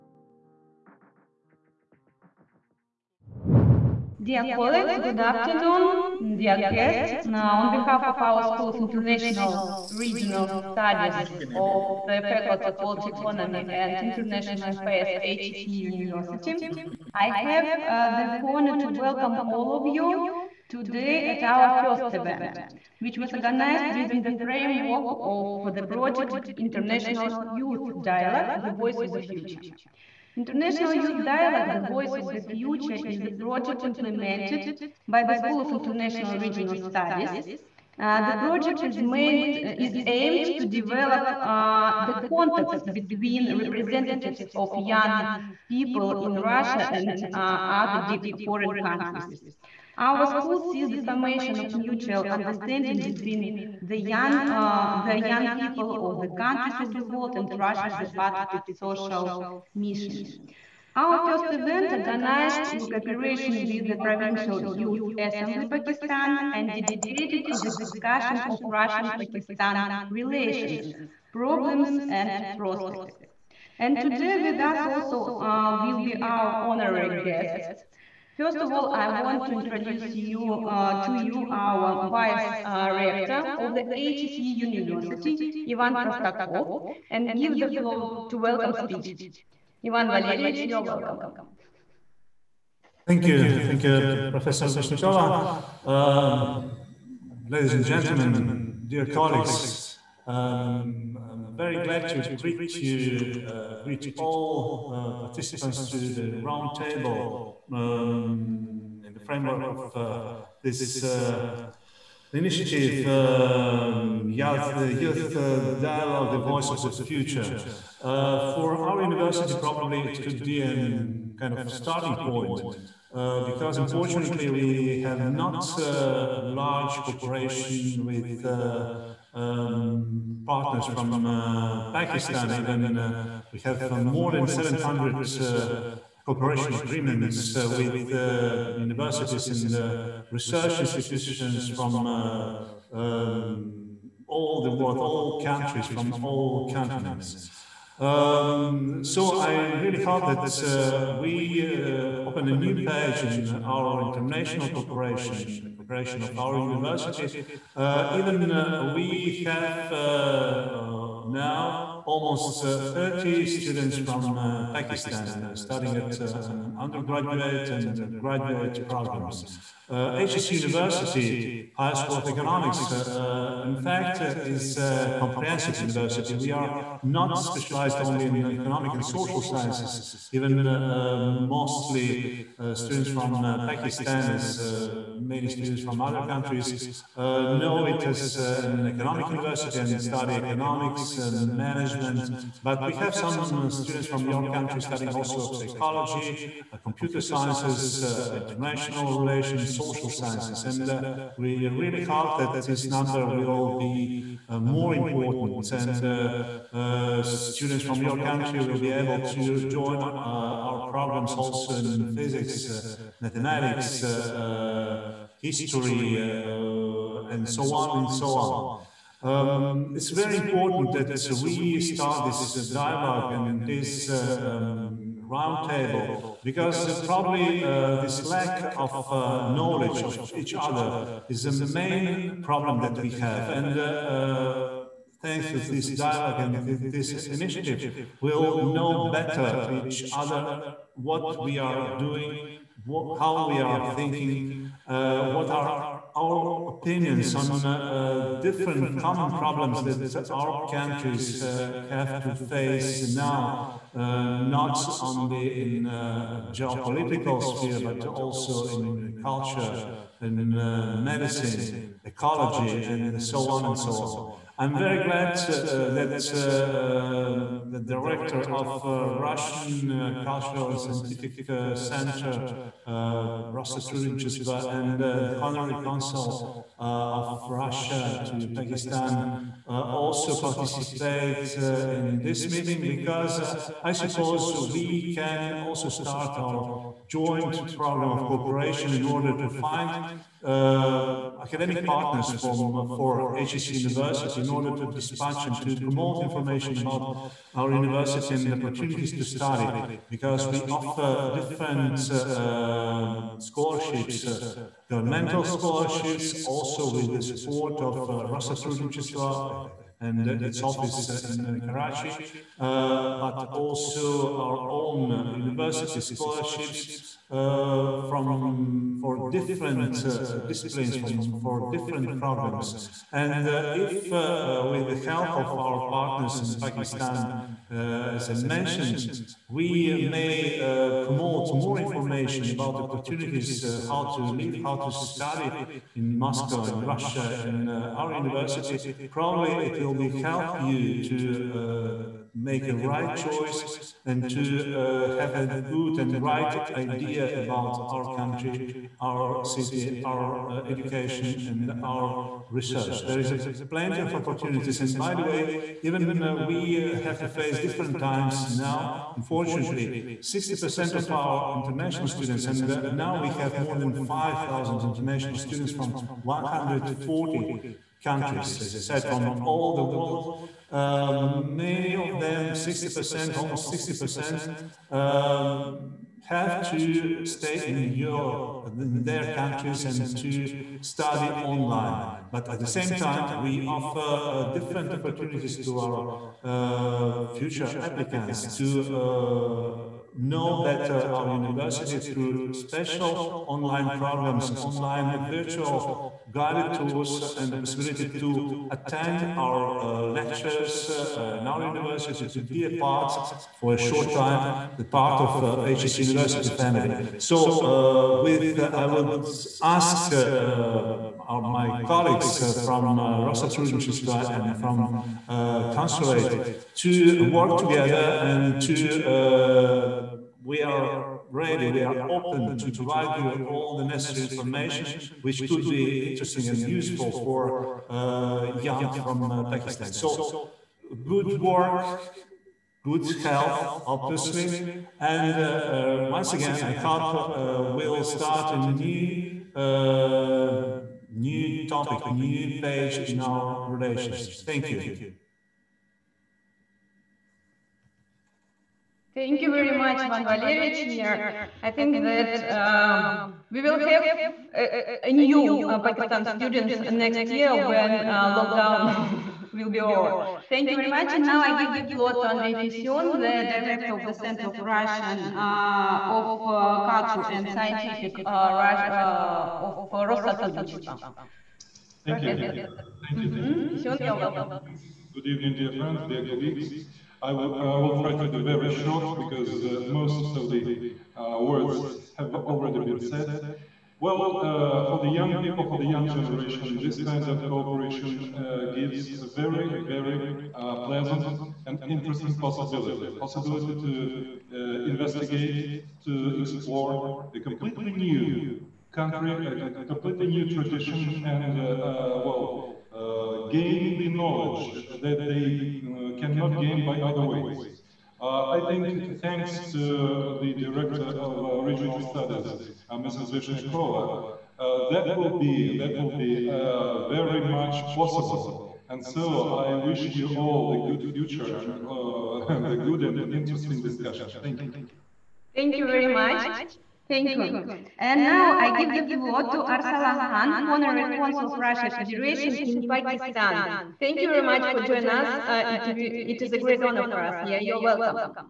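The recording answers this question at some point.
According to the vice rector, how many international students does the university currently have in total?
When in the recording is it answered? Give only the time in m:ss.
6:03.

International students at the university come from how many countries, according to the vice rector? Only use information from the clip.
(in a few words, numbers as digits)
140.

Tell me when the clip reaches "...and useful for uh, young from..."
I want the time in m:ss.
7:06.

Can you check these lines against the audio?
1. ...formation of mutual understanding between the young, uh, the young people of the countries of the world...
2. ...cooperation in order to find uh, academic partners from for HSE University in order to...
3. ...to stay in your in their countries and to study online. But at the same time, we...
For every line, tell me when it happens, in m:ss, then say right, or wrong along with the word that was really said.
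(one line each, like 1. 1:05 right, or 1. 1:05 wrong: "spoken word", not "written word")
1. 0:50 right
2. 4:48 right
3. 6:16 right.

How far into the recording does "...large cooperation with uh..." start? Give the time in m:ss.
2:06.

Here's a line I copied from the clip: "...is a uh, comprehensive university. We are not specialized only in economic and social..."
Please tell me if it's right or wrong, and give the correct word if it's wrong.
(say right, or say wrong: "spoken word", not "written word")
right.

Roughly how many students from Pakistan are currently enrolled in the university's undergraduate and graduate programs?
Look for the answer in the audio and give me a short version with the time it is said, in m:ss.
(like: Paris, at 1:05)
almost 30, at 2:42.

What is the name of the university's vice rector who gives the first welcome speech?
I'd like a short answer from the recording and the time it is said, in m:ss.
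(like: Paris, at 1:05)
Ivan Prostakov, at 1:25.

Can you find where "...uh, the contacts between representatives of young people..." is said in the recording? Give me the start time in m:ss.
0:41.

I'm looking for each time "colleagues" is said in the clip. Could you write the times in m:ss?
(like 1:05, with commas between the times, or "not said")
0:04, 1:39, 6:51, 7:56.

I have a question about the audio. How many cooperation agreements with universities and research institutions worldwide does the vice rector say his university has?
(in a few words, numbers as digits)
more than 700.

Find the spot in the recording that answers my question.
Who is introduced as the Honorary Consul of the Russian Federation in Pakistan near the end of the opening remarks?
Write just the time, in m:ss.
8:49.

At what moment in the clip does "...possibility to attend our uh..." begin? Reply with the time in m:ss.
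6:37.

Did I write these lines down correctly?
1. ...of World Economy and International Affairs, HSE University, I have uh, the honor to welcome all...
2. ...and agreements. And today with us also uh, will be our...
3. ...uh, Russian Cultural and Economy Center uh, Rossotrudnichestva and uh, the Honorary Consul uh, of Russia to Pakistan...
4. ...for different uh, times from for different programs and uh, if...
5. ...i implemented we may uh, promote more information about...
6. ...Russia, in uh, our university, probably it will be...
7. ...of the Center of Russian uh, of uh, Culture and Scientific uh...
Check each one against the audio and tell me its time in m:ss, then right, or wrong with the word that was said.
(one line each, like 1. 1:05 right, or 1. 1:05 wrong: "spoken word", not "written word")
1. 0:12 right
2. 1:12 wrong: "prospects", not "agreements"
3. 4:28 wrong: "Scientific", not "Economy"
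4. 5:18 wrong: "disciplines", not "times"
5. 5:28 wrong: "mentioned", not "implemented"
6. 5:36 right
7. 7:43 right.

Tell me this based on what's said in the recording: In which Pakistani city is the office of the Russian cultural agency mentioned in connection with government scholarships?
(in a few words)
Karachi.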